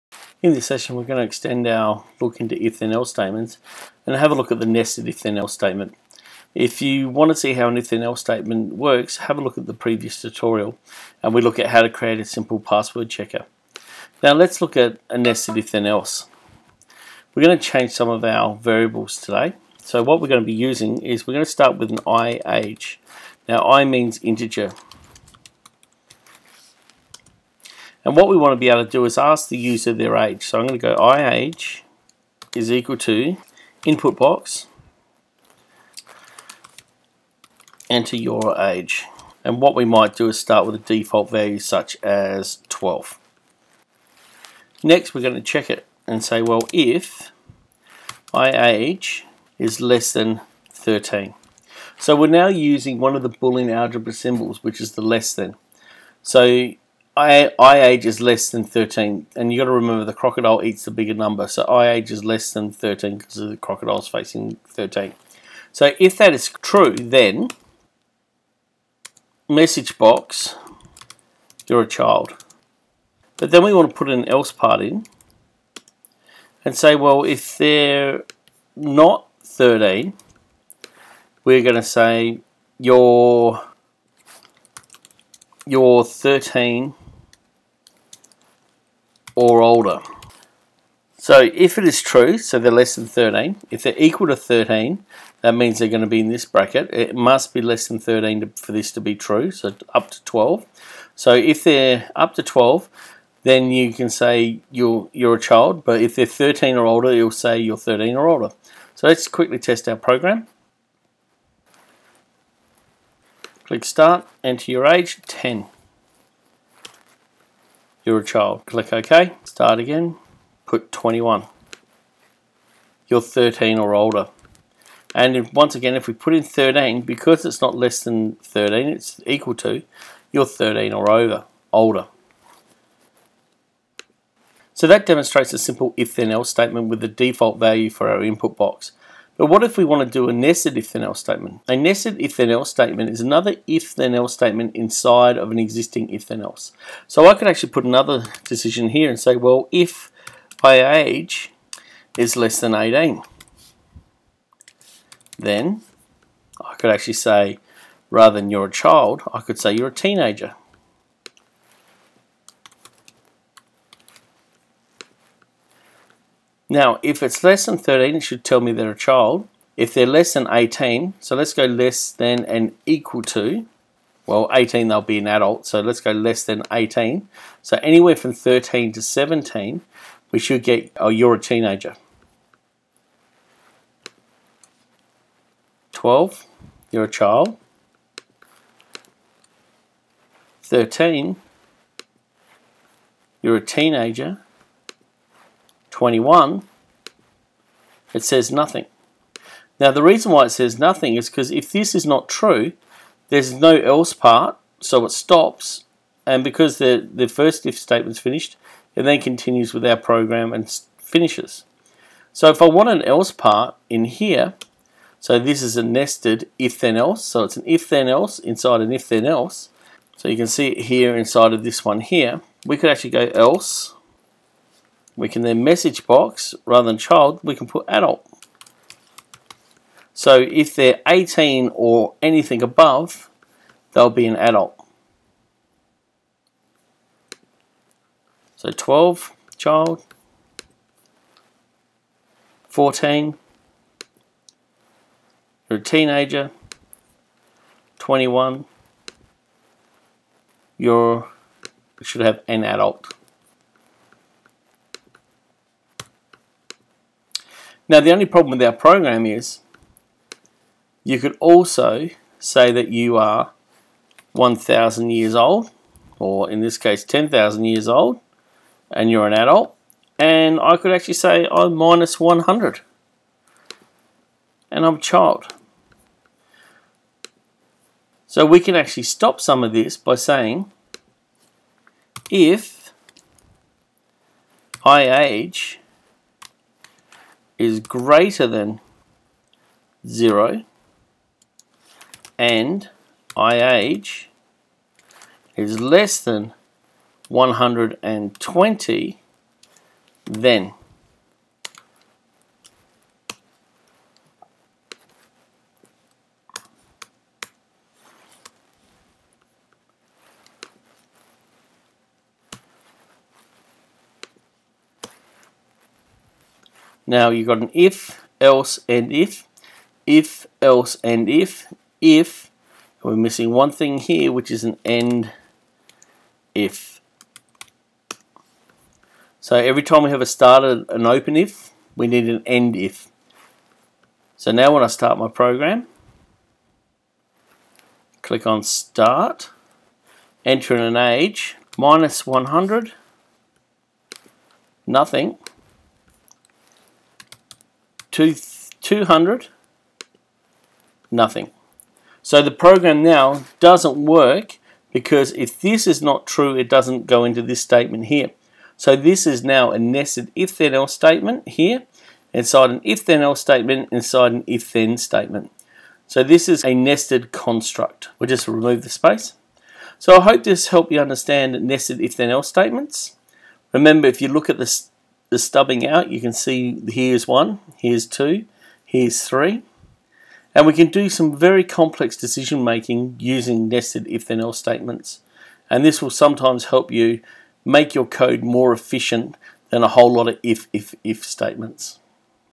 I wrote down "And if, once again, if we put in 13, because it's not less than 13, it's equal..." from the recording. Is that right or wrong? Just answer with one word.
right.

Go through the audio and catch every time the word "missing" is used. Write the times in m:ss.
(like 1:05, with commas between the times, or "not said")
5:23.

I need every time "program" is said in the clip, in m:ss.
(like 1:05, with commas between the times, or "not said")
1:49, 3:29, 4:18, 5:35, 5:52.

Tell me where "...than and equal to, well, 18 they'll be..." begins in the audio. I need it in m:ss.
2:52.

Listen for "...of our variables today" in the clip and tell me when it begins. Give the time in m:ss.
0:18.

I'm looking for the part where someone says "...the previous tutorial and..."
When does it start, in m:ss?
0:09.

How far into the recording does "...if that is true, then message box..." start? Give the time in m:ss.
1:05.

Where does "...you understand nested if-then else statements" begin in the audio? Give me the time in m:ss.
6:10.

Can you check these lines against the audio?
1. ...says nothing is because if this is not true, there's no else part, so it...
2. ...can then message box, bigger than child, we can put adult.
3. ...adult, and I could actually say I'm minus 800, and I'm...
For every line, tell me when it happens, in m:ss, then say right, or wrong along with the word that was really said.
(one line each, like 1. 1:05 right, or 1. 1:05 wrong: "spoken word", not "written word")
1. 3:20 right
2. 3:45 wrong: "rather", not "bigger"
3. 4:29 wrong: "100", not "800".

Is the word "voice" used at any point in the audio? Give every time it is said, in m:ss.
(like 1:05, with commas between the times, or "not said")
not said.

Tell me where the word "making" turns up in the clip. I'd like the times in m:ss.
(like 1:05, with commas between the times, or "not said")
6:22.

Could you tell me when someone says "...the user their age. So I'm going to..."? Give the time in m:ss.
0:29.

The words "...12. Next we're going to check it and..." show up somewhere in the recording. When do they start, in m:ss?
0:42.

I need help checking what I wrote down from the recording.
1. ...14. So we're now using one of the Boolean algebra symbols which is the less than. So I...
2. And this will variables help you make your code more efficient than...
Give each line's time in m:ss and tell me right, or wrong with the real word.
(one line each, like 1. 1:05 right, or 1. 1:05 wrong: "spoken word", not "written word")
1. 0:50 wrong: "13", not "14"
2. 6:25 wrong: "sometimes", not "variables".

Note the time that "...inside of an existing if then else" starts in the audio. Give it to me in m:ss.
2:24.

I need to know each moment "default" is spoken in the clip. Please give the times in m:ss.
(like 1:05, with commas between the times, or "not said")
0:40, 2:17.